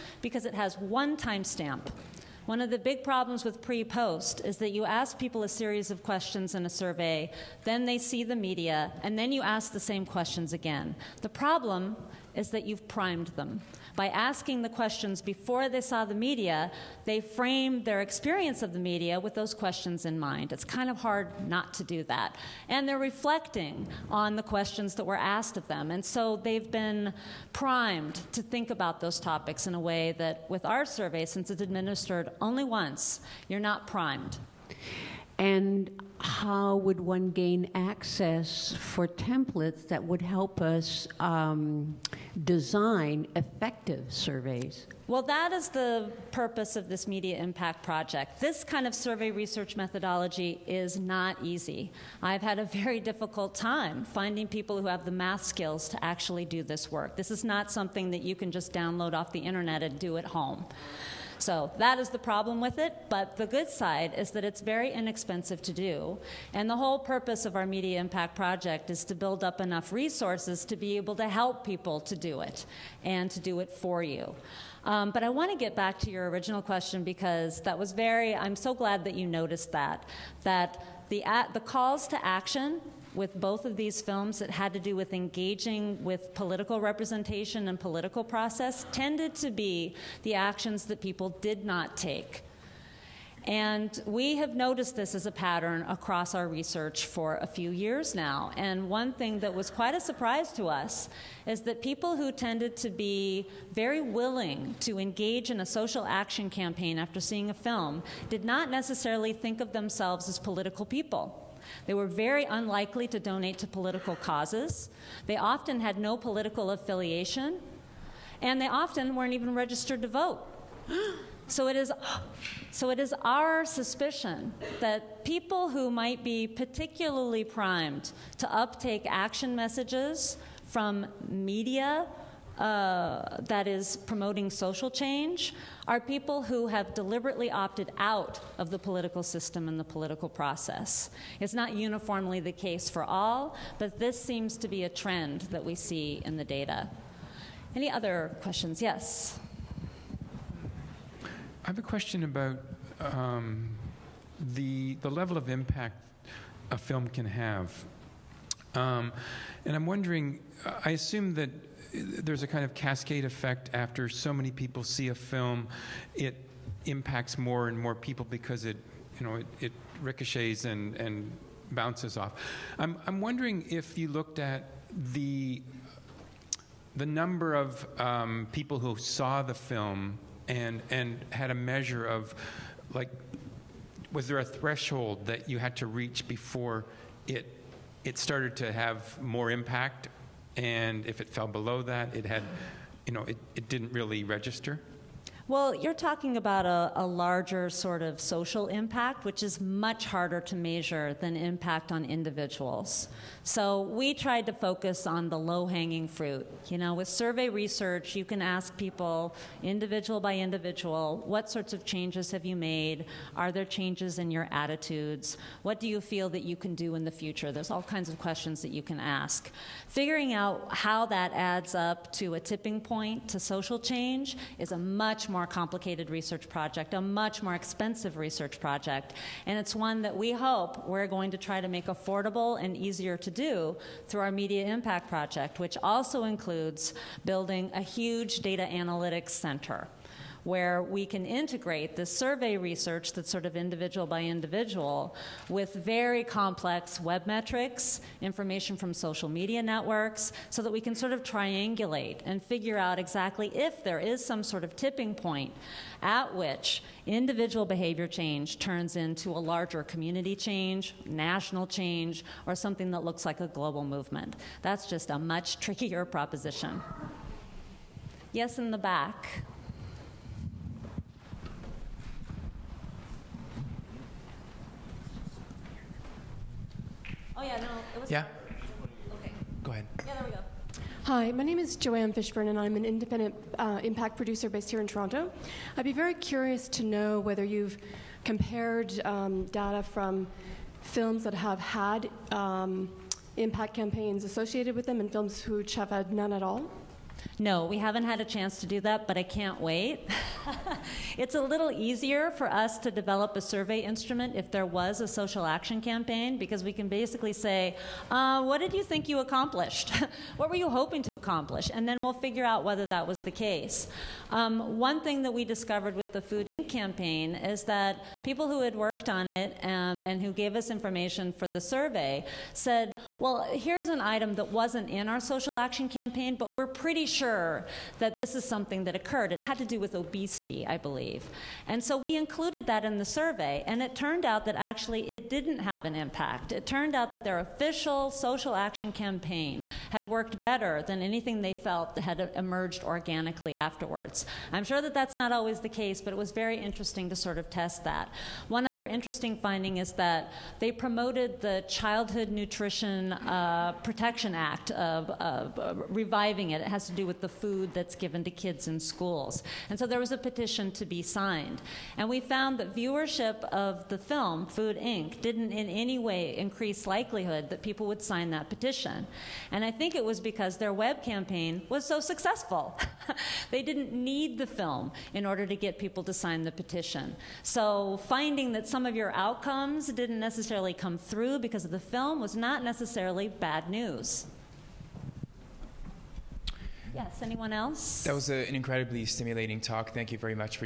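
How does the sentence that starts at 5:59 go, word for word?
And so there was a petition to be be signed.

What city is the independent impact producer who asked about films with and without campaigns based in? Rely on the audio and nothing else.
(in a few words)
Toronto.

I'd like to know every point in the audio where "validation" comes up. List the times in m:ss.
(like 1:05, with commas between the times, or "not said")
not said.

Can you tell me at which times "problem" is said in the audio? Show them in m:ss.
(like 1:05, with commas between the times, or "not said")
0:03, 0:11, 1:02.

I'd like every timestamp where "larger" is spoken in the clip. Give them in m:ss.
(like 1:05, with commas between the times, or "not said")
3:17, 4:19.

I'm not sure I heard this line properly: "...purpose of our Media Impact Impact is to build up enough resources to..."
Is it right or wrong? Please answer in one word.
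wrong.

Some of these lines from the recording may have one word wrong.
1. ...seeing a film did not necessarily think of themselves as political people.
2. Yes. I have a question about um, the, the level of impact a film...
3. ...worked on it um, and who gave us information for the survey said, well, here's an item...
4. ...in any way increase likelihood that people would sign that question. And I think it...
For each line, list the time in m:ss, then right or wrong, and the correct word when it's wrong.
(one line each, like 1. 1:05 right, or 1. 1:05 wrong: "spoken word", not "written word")
1. 1:47 right
2. 2:28 right
3. 5:18 right
4. 6:05 wrong: "petition", not "question".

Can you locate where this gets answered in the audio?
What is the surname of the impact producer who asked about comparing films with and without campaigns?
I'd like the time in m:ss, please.
4:42.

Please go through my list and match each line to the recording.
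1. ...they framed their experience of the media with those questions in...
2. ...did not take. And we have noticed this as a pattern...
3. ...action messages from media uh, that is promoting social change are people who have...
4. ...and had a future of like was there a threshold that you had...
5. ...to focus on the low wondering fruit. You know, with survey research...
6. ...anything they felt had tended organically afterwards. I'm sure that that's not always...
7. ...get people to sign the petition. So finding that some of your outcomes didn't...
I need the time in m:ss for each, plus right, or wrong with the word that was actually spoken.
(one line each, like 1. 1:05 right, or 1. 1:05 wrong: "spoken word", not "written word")
1. 0:17 right
2. 1:31 right
3. 2:09 right
4. 3:00 wrong: "measure", not "future"
5. 3:24 wrong: "hanging", not "wondering"
6. 5:41 wrong: "emerged", not "tended"
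7. 6:15 right.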